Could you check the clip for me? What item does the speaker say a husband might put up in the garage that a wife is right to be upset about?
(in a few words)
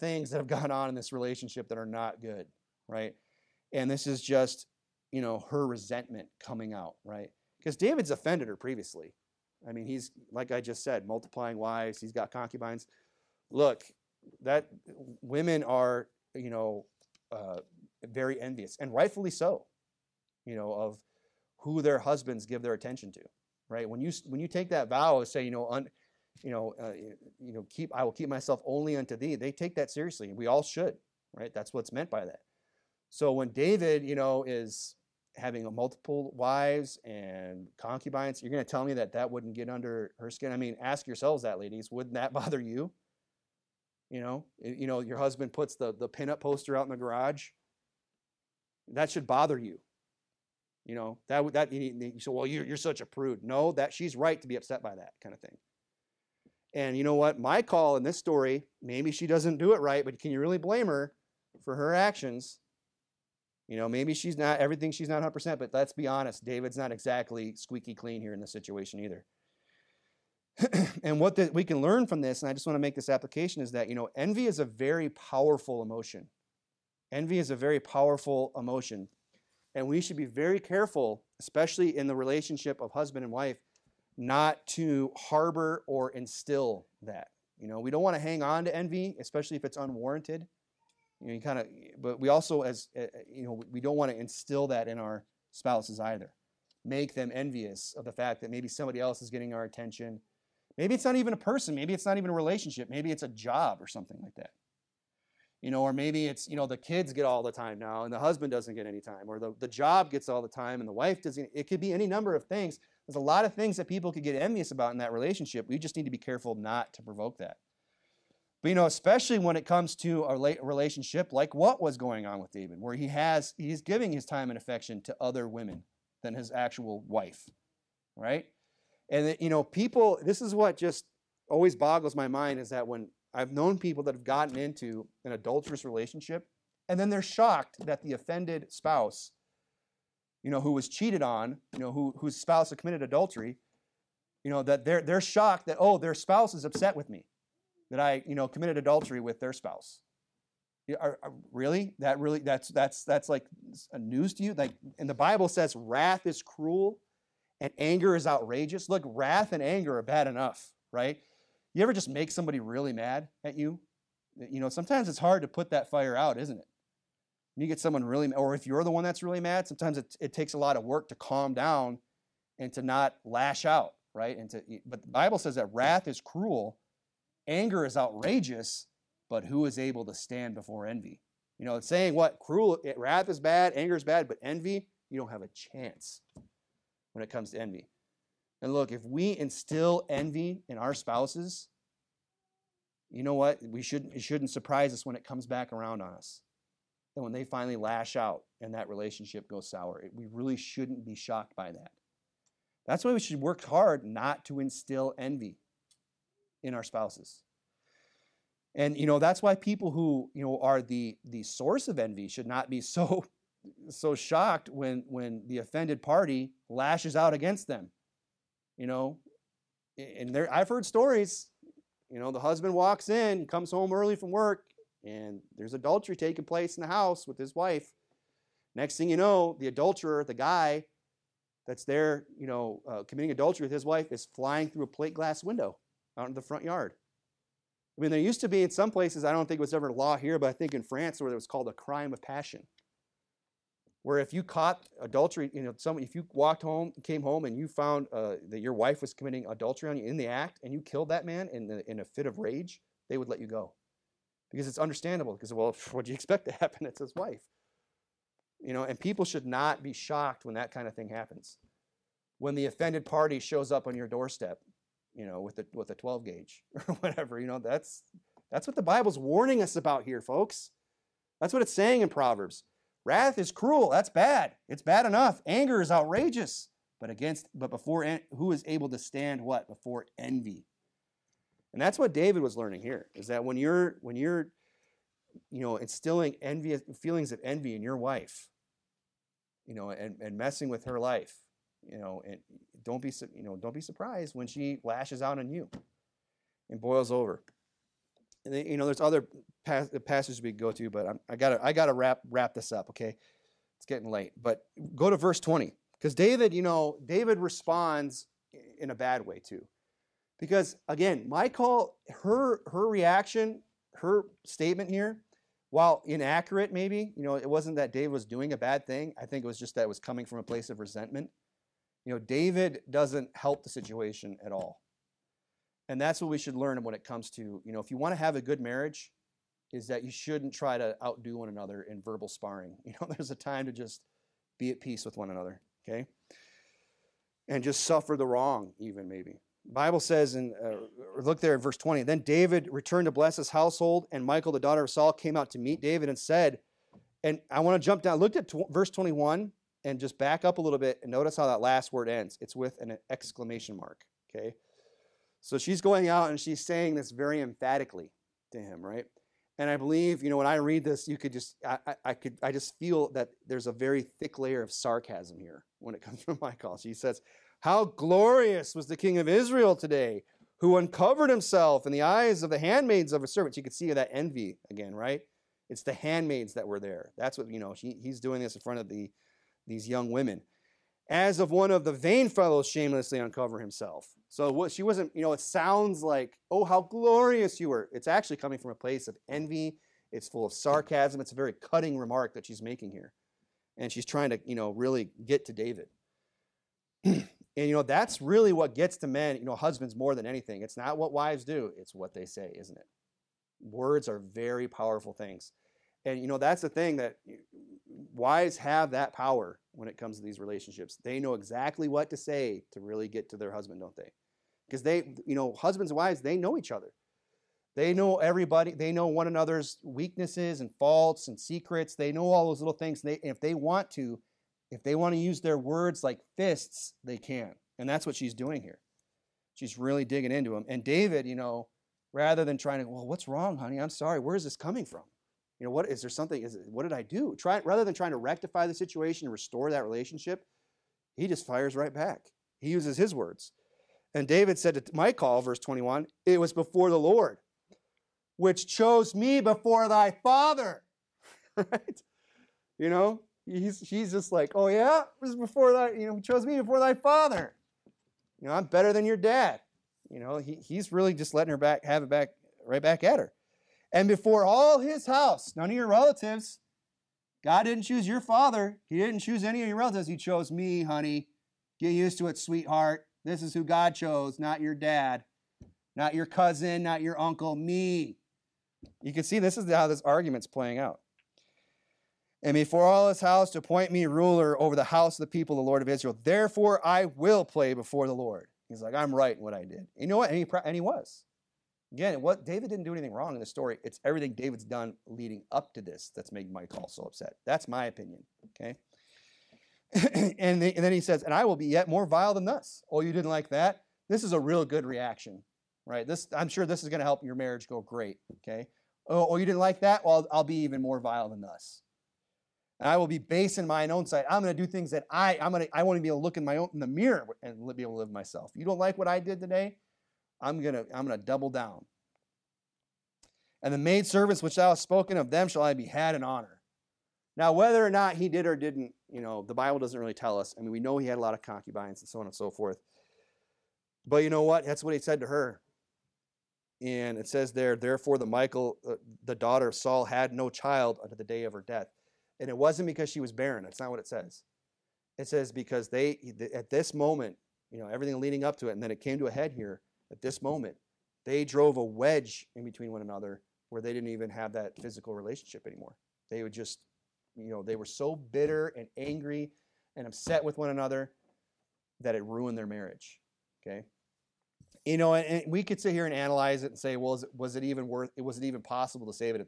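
Pinup poster.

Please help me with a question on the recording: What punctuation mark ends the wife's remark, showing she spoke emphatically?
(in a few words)
Exclamation mark.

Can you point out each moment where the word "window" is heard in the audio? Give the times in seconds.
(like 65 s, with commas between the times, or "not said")
235 s.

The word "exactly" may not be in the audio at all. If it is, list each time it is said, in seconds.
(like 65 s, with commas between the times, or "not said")
66 s, 411 s.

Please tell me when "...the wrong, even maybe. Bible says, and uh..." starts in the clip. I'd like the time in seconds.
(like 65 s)
338 s.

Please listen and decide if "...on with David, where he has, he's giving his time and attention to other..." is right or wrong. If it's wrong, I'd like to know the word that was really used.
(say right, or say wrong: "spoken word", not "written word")
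wrong: "affection", not "attention".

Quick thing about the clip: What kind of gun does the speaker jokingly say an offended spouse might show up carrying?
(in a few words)
12 gauge.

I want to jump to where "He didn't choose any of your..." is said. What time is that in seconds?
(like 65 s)
468 s.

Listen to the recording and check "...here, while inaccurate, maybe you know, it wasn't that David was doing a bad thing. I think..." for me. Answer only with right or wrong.
right.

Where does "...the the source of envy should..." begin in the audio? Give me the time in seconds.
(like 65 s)
210 s.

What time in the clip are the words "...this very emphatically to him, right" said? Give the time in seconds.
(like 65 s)
356 s.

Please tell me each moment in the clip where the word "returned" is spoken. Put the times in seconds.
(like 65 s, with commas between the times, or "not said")
342 s.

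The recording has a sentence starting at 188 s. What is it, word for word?
And look, if we instill envy in our spouses, you know what?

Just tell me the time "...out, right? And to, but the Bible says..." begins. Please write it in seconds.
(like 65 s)
173 s.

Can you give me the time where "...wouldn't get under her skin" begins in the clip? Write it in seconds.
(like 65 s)
39 s.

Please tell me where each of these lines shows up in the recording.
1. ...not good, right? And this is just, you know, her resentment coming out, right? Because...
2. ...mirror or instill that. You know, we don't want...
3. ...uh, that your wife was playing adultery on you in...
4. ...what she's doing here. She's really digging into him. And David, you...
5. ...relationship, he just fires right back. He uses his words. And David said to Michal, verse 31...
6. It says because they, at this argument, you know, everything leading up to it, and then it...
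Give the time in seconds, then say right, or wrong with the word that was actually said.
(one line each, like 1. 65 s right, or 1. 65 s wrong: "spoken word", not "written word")
1. 1 s right
2. 85 s wrong: "harbor", not "mirror"
3. 248 s wrong: "committing", not "playing"
4. 428 s right
5. 439 s wrong: "21", not "31"
6. 545 s wrong: "moment", not "argument".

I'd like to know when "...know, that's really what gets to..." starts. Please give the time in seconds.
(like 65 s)
397 s.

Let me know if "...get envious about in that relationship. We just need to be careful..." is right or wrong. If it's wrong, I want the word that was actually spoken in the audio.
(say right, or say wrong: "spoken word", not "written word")
right.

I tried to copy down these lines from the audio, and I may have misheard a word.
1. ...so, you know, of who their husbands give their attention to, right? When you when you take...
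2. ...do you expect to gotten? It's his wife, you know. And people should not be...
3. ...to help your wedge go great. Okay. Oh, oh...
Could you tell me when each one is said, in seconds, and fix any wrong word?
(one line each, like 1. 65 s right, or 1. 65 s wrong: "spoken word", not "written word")
1. 19 s right
2. 256 s wrong: "happen", not "gotten"
3. 506 s wrong: "marriage", not "wedge".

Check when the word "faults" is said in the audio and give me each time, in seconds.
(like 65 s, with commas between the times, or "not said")
420 s.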